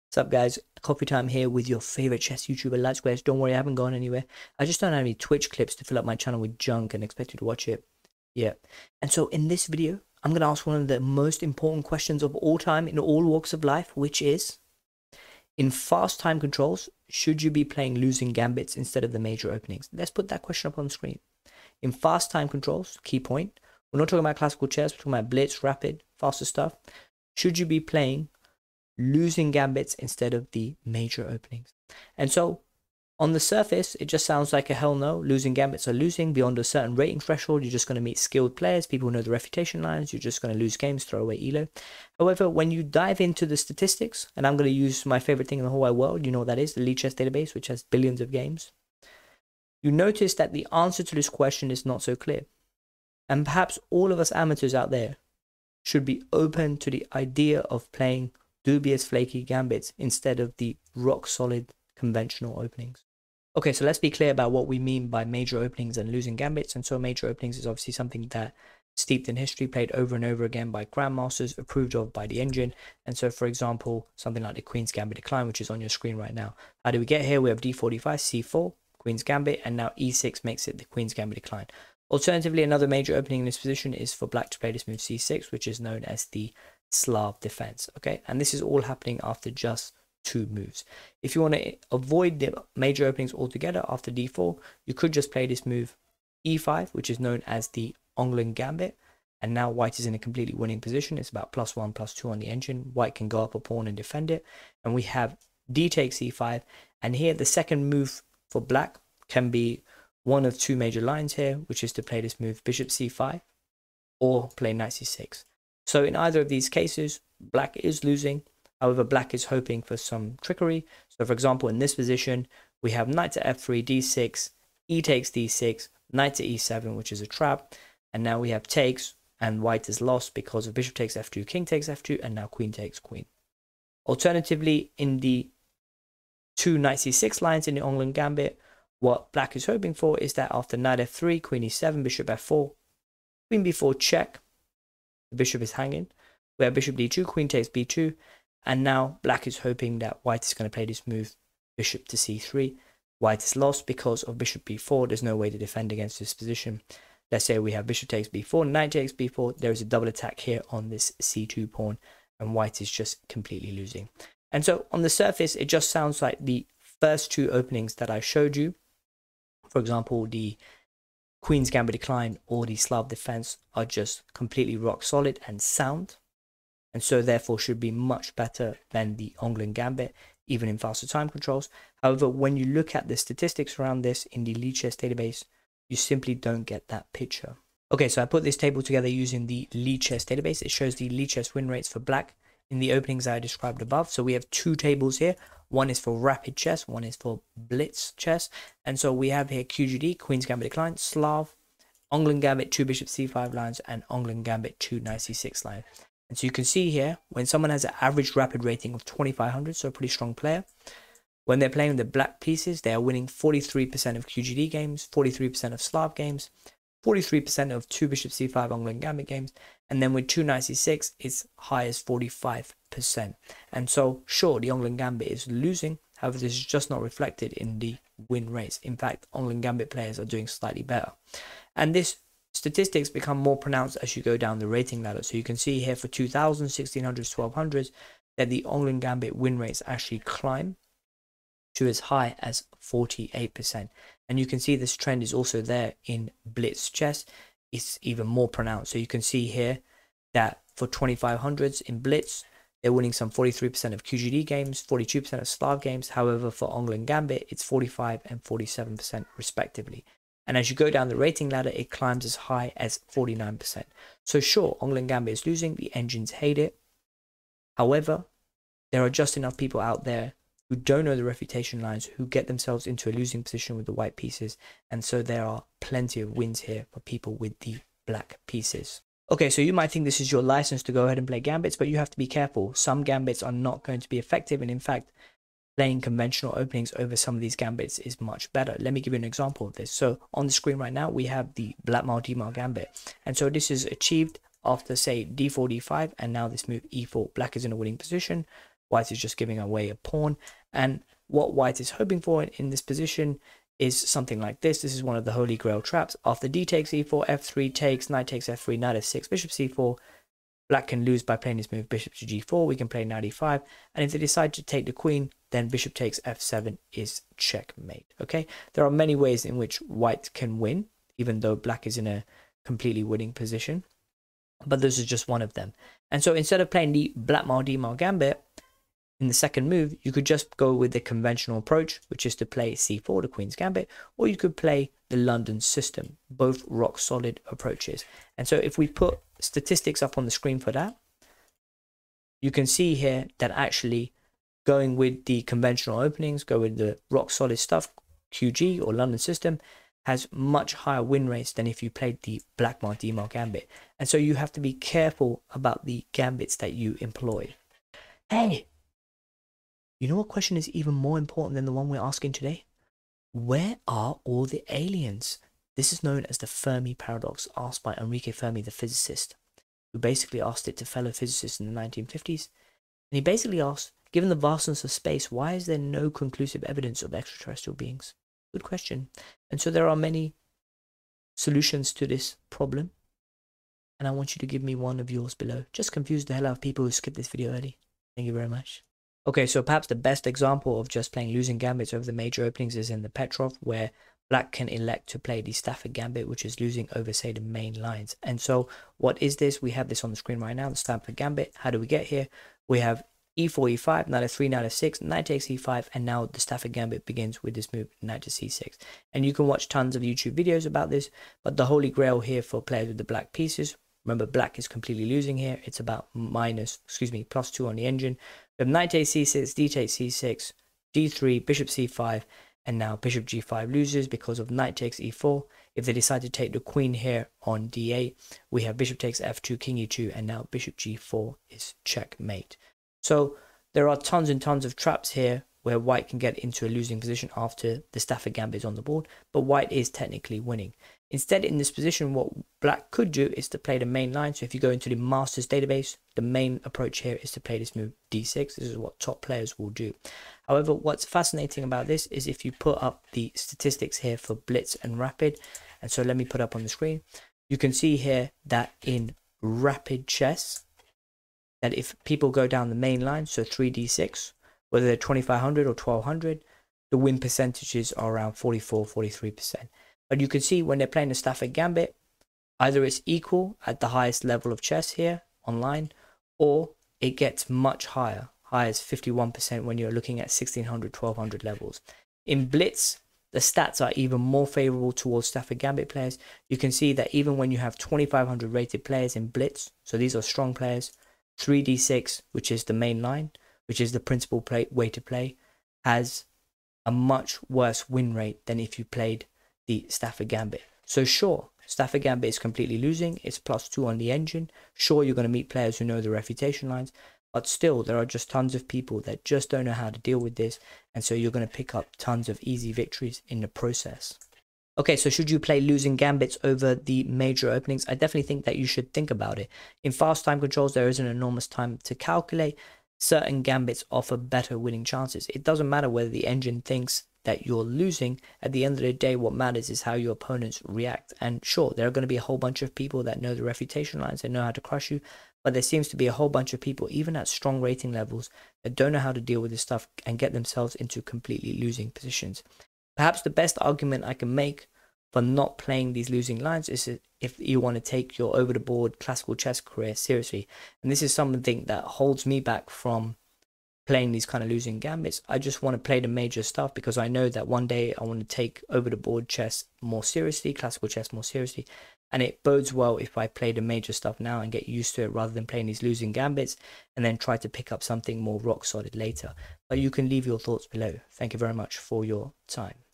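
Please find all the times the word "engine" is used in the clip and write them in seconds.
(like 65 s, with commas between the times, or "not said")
72 s, 102 s, 265 s, 417 s, 504 s, 526 s.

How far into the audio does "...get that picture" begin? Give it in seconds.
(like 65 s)
186 s.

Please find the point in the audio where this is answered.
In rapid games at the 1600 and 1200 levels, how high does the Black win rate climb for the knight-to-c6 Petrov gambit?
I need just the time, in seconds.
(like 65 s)
478 s.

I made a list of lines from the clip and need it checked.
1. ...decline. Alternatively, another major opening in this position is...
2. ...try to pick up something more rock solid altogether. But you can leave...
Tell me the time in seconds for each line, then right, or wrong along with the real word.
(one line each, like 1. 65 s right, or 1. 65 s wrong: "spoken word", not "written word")
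1. 81 s right
2. 567 s wrong: "later", not "altogether".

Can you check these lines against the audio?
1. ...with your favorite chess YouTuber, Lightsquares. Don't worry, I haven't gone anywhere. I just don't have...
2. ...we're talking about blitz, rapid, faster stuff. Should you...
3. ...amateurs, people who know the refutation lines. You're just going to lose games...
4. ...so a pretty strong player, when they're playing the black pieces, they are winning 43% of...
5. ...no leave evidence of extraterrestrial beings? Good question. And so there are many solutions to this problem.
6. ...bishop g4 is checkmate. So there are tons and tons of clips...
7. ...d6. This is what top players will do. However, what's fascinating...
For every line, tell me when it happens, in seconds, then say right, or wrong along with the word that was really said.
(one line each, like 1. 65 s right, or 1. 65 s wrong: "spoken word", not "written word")
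1. 1 s right
2. 24 s right
3. 38 s wrong: "players", not "amateurs"
4. 209 s right
5. 375 s wrong: "conclusive", not "leave"
6. 430 s wrong: "traps", not "clips"
7. 448 s right.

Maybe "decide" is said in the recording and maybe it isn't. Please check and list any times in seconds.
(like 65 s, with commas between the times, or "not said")
314 s, 425 s.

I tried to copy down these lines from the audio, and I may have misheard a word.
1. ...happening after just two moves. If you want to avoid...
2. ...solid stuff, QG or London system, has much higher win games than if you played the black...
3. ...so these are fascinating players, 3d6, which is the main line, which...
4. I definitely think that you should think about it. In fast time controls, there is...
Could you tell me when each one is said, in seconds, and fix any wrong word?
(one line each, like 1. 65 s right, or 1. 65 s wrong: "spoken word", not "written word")
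1. 88 s right
2. 347 s wrong: "rates", not "games"
3. 489 s wrong: "strong", not "fascinating"
4. 517 s right.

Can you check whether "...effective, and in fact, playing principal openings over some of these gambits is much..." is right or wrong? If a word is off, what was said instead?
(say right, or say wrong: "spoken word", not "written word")
wrong: "conventional", not "principal".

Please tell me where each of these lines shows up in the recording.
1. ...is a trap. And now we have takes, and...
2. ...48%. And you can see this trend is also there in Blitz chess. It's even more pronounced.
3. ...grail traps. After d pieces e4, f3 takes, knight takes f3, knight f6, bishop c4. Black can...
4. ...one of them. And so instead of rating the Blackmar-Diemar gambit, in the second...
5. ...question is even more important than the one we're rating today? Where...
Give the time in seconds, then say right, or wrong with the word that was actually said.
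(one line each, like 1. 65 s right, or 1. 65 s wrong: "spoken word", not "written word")
1. 127 s right
2. 242 s right
3. 305 s wrong: "takes", not "pieces"
4. 325 s wrong: "playing", not "rating"
5. 360 s wrong: "asking", not "rating".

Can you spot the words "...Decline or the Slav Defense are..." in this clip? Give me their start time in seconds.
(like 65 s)
171 s.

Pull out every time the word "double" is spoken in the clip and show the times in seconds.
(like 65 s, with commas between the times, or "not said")
159 s.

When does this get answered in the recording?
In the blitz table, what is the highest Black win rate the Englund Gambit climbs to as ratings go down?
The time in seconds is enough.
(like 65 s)
263 s.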